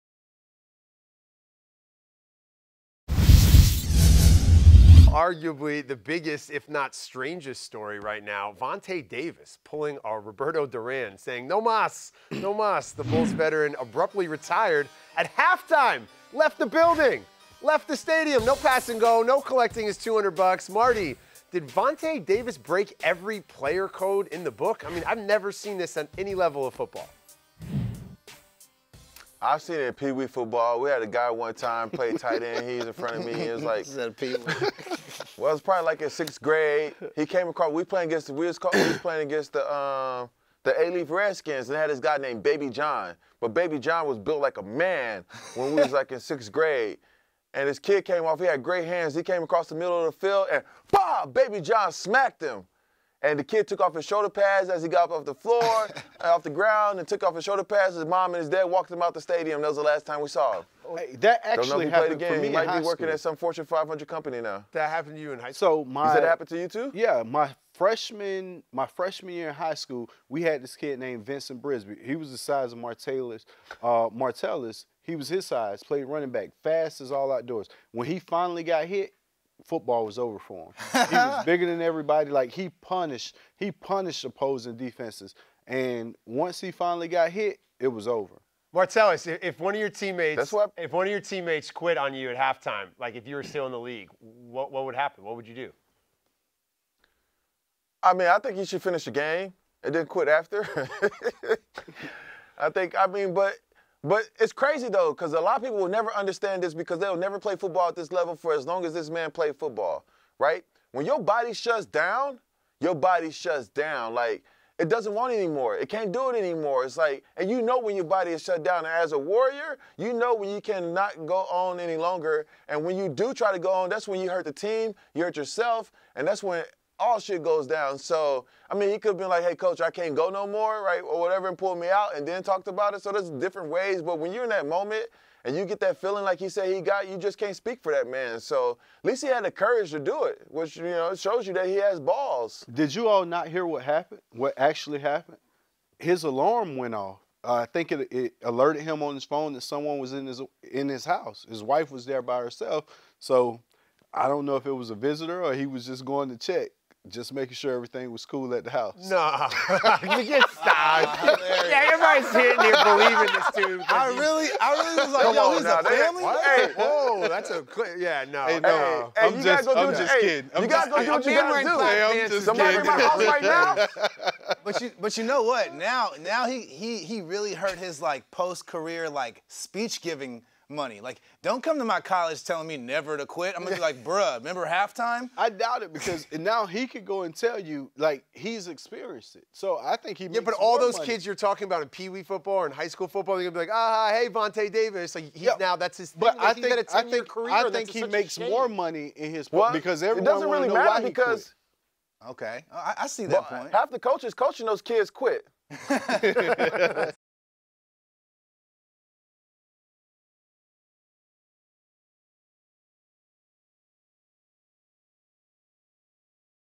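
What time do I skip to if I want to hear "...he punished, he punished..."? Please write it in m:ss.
1:22.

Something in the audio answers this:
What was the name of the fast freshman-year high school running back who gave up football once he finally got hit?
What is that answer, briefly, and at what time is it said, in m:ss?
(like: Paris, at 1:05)
Vincent Brisby, at 1:11.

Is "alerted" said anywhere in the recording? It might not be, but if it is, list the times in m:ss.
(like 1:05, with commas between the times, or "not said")
2:28.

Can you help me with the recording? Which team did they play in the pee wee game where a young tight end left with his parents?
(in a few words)
A Leaf Redskins.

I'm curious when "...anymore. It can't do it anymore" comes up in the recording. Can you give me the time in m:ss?
1:55.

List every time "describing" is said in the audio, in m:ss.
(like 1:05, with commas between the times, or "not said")
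not said.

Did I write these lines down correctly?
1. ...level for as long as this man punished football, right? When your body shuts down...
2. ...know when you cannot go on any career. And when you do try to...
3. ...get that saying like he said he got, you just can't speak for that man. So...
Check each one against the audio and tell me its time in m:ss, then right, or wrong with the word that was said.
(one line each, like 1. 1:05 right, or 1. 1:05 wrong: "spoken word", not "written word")
1. 1:48 wrong: "played", not "punished"
2. 2:00 wrong: "longer", not "career"
3. 2:15 wrong: "feeling", not "saying".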